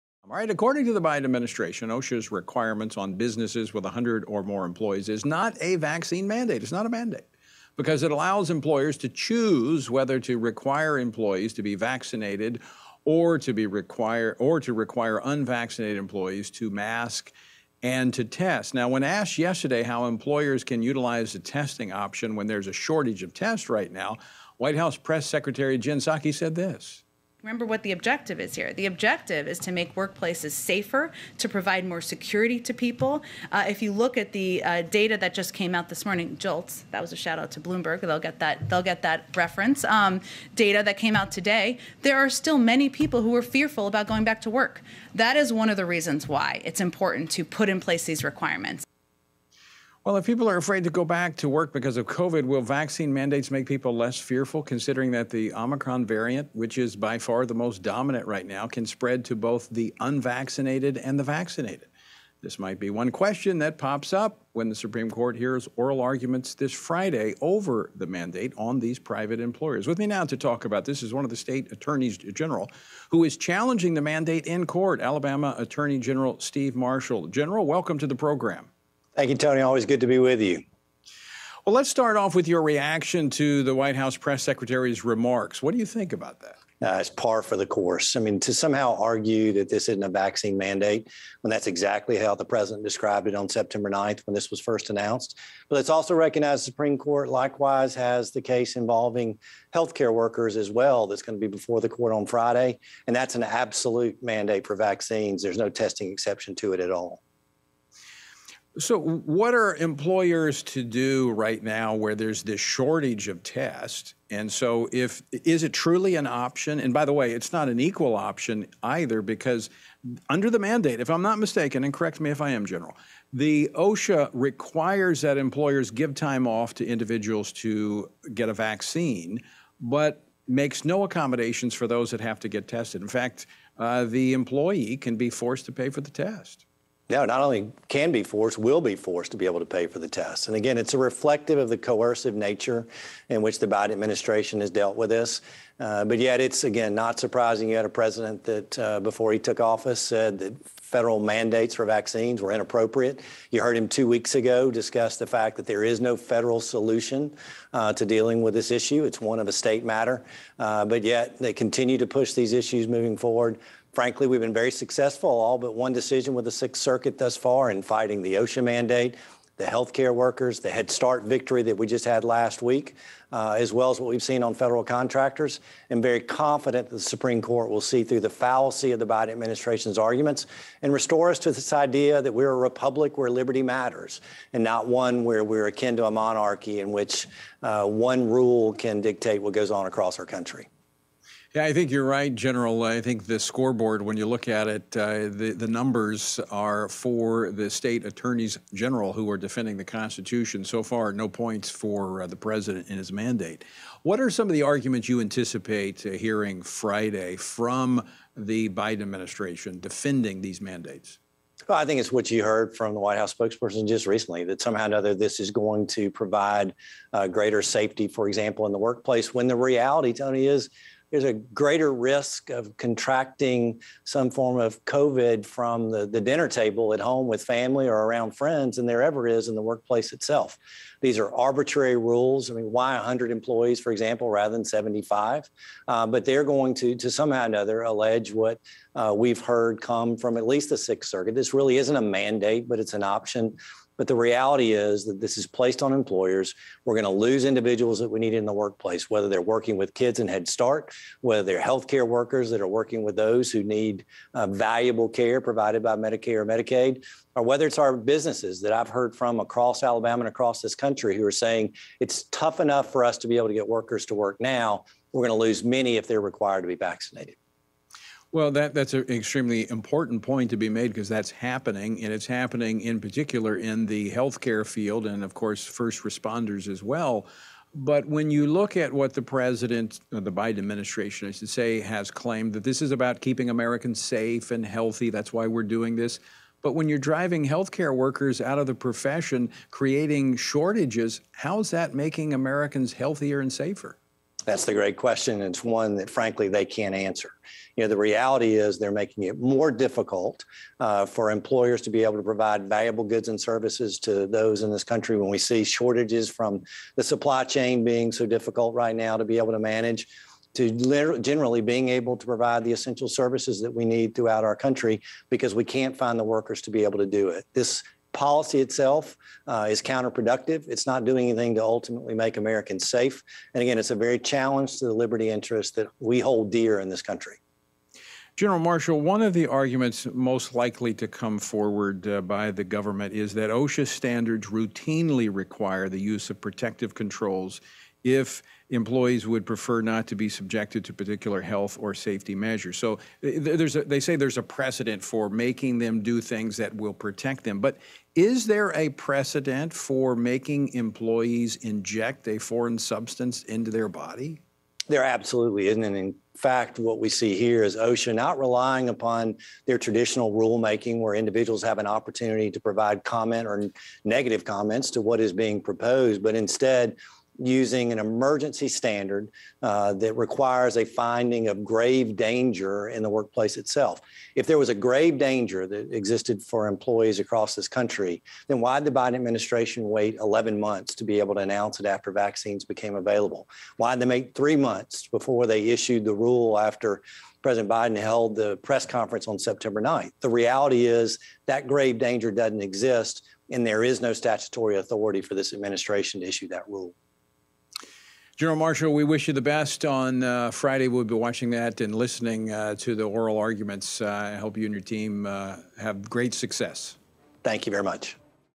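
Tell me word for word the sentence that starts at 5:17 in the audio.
This policy itself uh, is counterproductive.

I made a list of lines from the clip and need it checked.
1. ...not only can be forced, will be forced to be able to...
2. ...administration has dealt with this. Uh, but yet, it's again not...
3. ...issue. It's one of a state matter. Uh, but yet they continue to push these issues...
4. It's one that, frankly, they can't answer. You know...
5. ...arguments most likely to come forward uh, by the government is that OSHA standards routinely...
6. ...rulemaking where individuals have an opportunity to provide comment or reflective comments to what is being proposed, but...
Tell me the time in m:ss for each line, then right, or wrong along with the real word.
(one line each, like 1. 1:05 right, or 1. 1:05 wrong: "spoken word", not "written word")
1. 2:17 right
2. 2:23 right
3. 2:38 right
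4. 4:55 right
5. 5:29 right
6. 6:00 wrong: "negative", not "reflective".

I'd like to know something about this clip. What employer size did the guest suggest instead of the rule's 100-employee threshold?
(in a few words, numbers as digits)
75.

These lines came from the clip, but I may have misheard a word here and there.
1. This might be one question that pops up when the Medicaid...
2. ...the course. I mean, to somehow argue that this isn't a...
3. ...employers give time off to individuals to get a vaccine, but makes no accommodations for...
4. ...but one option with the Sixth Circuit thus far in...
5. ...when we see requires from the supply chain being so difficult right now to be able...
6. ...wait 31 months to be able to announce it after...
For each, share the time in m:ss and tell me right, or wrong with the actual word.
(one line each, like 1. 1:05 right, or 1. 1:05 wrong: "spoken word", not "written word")
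1. 1:02 wrong: "Supreme", not "Medicaid"
2. 1:27 right
3. 2:05 right
4. 2:45 wrong: "decision", not "option"
5. 5:05 wrong: "shortages", not "requires"
6. 6:19 wrong: "11", not "31".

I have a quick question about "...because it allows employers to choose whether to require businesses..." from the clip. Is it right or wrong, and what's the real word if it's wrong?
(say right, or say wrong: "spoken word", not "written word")
wrong: "employees", not "businesses".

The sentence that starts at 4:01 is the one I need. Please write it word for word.
This really isn't a mandate, but it's an option but the reality is that this is placed on employers.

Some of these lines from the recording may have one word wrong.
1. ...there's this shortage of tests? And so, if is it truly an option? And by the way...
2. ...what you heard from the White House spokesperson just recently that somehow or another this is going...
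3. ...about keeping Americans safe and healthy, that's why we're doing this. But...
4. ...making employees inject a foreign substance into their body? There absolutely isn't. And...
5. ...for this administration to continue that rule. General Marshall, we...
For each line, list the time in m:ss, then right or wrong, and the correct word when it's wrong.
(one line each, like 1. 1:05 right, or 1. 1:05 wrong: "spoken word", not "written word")
1. 1:52 right
2. 3:32 right
3. 4:42 right
4. 5:50 right
5. 6:35 wrong: "issue", not "continue".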